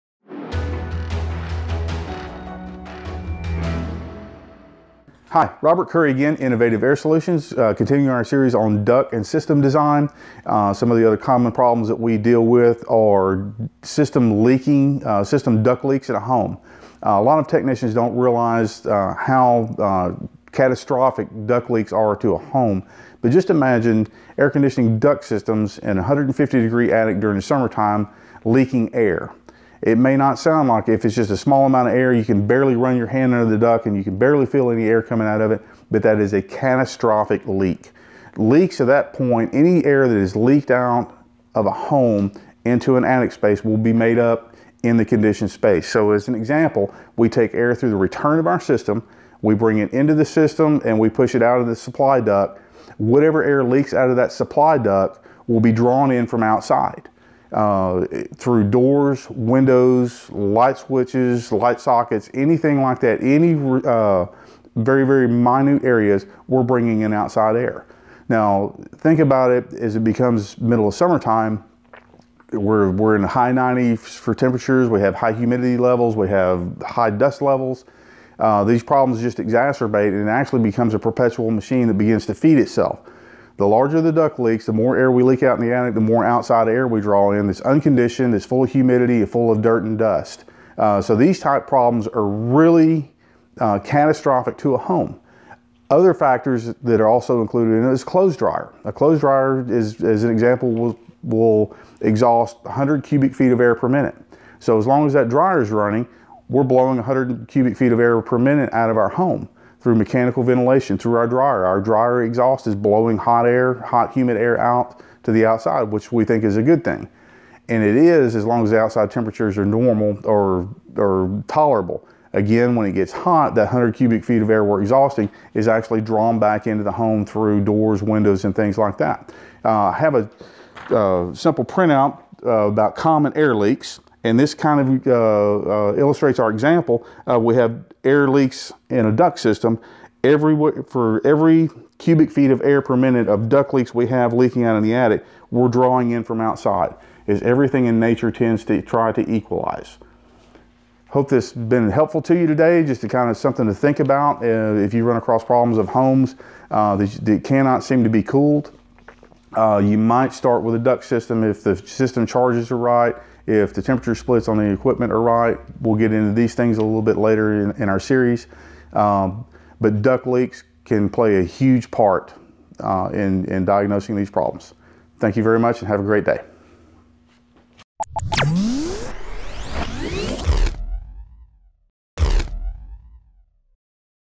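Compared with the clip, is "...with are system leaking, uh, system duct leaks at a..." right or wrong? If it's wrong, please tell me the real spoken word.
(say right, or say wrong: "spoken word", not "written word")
right.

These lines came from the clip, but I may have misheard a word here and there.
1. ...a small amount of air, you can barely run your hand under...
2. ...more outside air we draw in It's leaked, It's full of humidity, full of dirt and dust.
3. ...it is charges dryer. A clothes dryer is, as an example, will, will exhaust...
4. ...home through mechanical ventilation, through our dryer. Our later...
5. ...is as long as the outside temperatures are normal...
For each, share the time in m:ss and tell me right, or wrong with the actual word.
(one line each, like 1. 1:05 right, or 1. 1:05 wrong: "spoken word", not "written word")
1. 0:31 right
2. 1:26 wrong: "unconditioned", not "leaked"
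3. 1:37 wrong: "clothes", not "charges"
4. 1:49 wrong: "dryer", not "later"
5. 1:57 right.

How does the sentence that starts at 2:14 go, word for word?
And this kind of uh, uh, illustrates our example.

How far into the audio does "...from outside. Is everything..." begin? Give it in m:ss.
2:26.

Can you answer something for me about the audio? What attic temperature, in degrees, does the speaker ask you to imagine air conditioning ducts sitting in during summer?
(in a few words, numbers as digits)
150.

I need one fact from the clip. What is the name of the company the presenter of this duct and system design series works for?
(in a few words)
Innovative Air Solutions.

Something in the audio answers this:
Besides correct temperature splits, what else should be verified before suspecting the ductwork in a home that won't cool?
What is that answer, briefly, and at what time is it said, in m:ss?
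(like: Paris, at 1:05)
system charges, at 2:41.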